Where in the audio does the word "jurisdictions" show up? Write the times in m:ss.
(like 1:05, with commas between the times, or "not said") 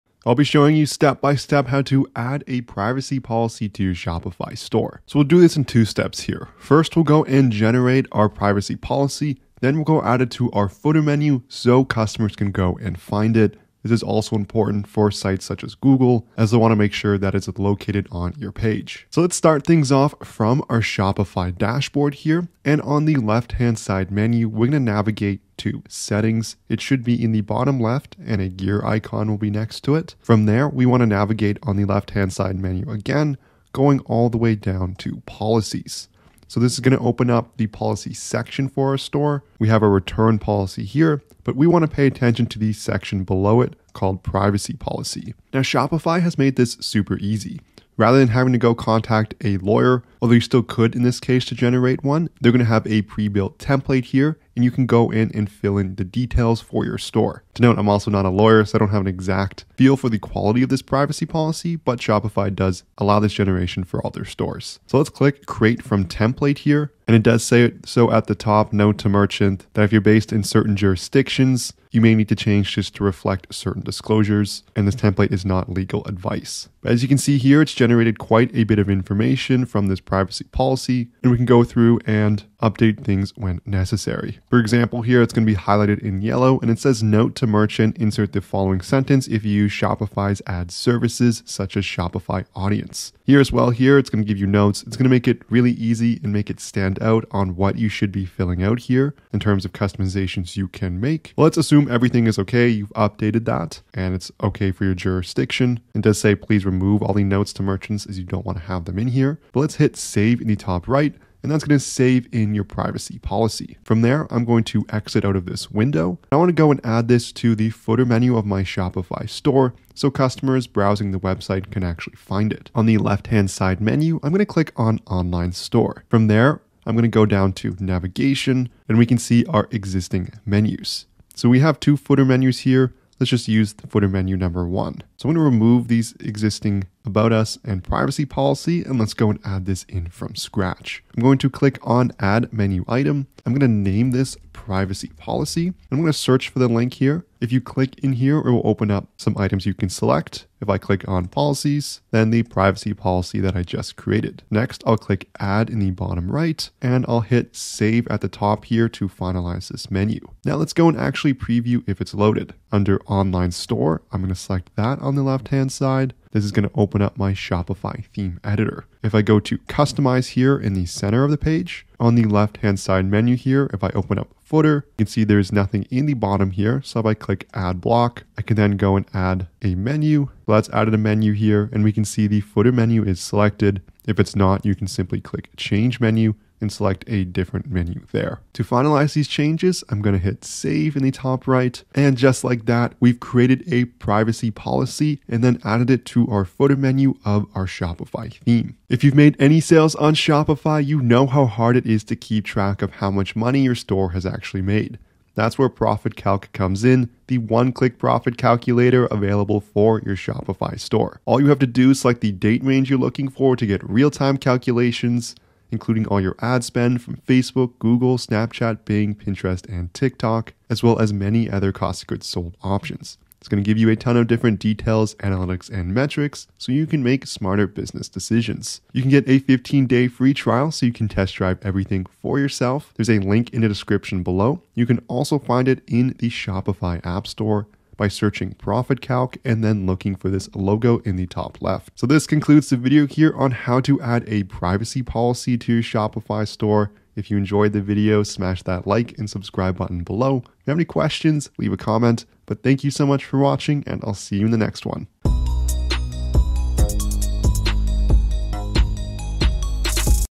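1:10, 1:44.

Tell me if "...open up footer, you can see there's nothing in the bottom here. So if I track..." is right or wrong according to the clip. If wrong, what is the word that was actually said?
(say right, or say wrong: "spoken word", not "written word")
wrong: "click", not "track".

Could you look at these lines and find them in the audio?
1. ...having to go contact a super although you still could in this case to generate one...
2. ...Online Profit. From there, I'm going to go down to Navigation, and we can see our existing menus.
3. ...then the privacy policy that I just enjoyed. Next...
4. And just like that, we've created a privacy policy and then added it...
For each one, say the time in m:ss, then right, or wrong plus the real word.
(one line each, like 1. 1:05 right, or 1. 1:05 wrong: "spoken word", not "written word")
1. 0:48 wrong: "lawyer", not "super"
2. 2:05 wrong: "Store", not "Profit"
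3. 2:32 wrong: "created", not "enjoyed"
4. 3:11 right.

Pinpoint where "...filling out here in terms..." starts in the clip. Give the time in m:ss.
1:38.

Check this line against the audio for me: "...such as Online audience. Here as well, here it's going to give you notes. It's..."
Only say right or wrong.
wrong.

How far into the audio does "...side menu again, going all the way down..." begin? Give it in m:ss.
0:32.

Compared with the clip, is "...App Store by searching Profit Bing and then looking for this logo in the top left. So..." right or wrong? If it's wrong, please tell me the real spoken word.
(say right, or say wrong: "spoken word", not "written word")
wrong: "Calc", not "Bing".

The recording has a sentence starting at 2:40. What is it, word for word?
Now let's go and actually preview if it's loaded.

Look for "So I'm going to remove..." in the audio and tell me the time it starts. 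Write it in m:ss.
2:15.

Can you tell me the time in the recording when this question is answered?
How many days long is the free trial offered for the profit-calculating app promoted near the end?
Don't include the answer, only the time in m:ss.
3:49.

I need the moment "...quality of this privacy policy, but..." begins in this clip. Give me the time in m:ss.
1:00.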